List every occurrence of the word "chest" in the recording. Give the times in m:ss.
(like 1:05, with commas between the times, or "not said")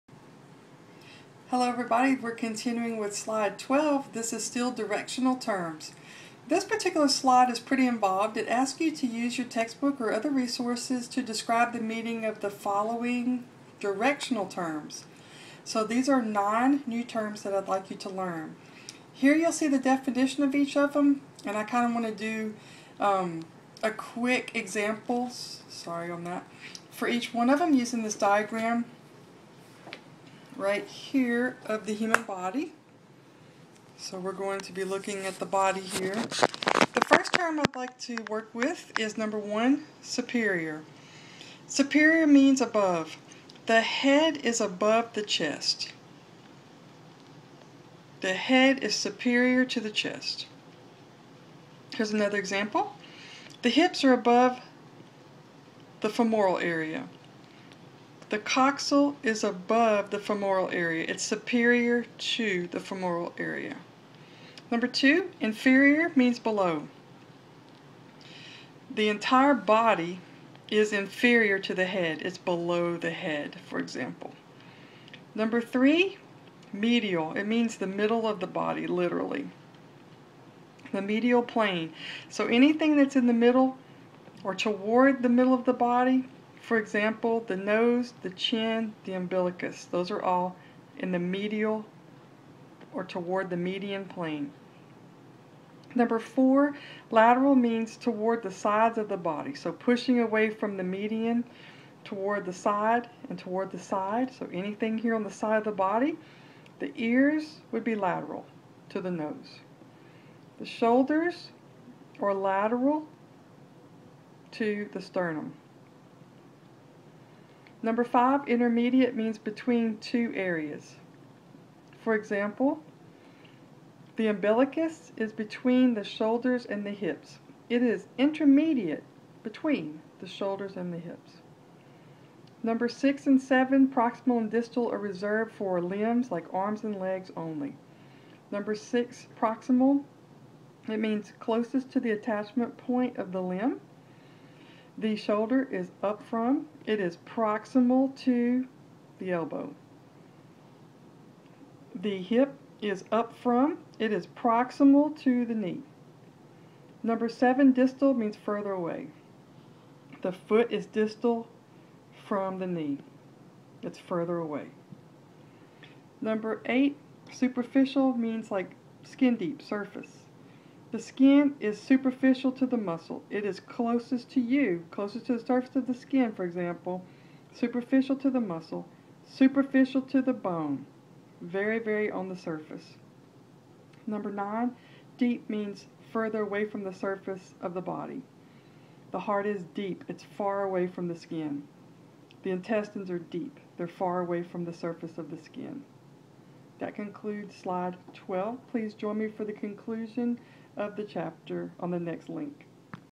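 0:45, 0:49.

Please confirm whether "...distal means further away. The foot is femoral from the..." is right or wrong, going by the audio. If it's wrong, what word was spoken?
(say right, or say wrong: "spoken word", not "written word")
wrong: "distal", not "femoral".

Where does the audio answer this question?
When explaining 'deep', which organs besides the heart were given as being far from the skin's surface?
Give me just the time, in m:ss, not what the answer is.
3:12.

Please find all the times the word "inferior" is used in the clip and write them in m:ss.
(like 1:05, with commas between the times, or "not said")
1:05, 1:10.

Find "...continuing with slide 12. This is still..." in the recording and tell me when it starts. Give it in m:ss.
0:02.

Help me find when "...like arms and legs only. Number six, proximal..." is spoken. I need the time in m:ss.
2:16.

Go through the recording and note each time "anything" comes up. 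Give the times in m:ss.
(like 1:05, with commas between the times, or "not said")
1:22, 1:44.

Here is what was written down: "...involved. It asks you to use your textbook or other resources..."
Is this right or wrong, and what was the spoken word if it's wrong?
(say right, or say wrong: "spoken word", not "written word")
right.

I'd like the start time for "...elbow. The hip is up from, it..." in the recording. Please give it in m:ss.
2:29.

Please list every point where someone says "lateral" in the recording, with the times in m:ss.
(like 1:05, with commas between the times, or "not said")
1:37, 1:47, 1:52.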